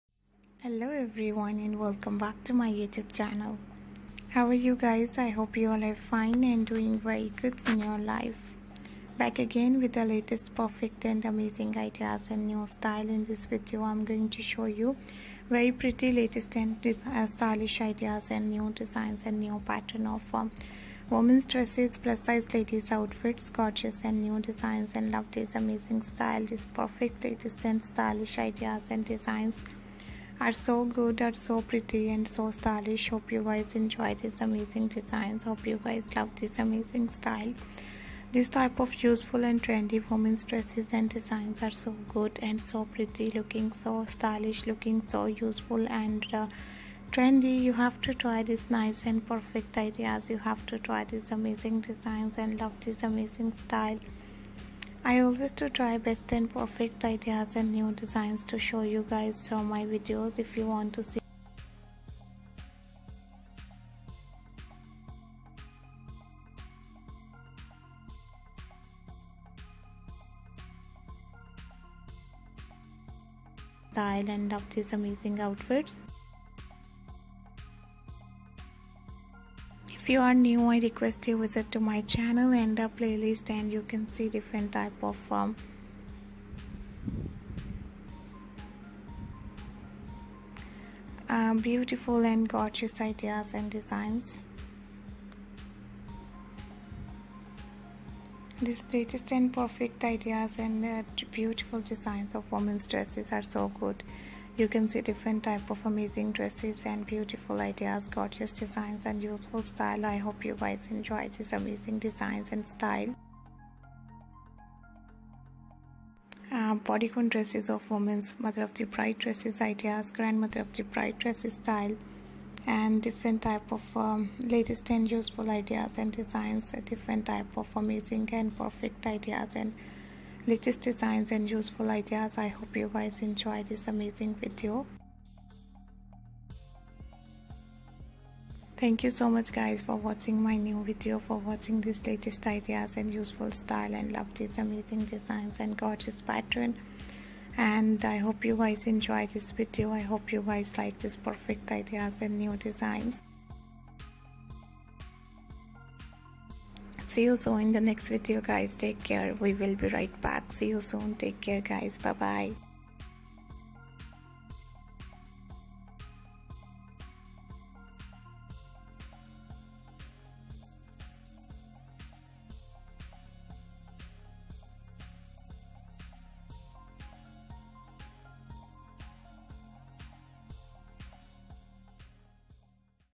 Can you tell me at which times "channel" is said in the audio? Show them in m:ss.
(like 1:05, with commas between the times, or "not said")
0:03, 1:22.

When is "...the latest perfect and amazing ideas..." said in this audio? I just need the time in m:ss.
0:09.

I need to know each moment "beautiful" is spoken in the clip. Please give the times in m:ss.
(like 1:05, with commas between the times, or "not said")
1:31, 1:41, 1:47.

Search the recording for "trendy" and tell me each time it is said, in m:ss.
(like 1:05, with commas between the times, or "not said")
0:39, 0:47.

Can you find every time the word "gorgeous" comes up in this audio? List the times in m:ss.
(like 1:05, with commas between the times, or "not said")
0:23, 1:32, 1:48, 2:25.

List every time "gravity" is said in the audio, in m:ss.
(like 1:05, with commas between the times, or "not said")
not said.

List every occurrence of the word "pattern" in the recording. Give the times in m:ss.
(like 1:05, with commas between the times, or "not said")
0:19, 2:26.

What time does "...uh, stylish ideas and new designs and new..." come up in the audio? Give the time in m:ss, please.
0:17.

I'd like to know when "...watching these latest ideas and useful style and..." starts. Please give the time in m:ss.
2:21.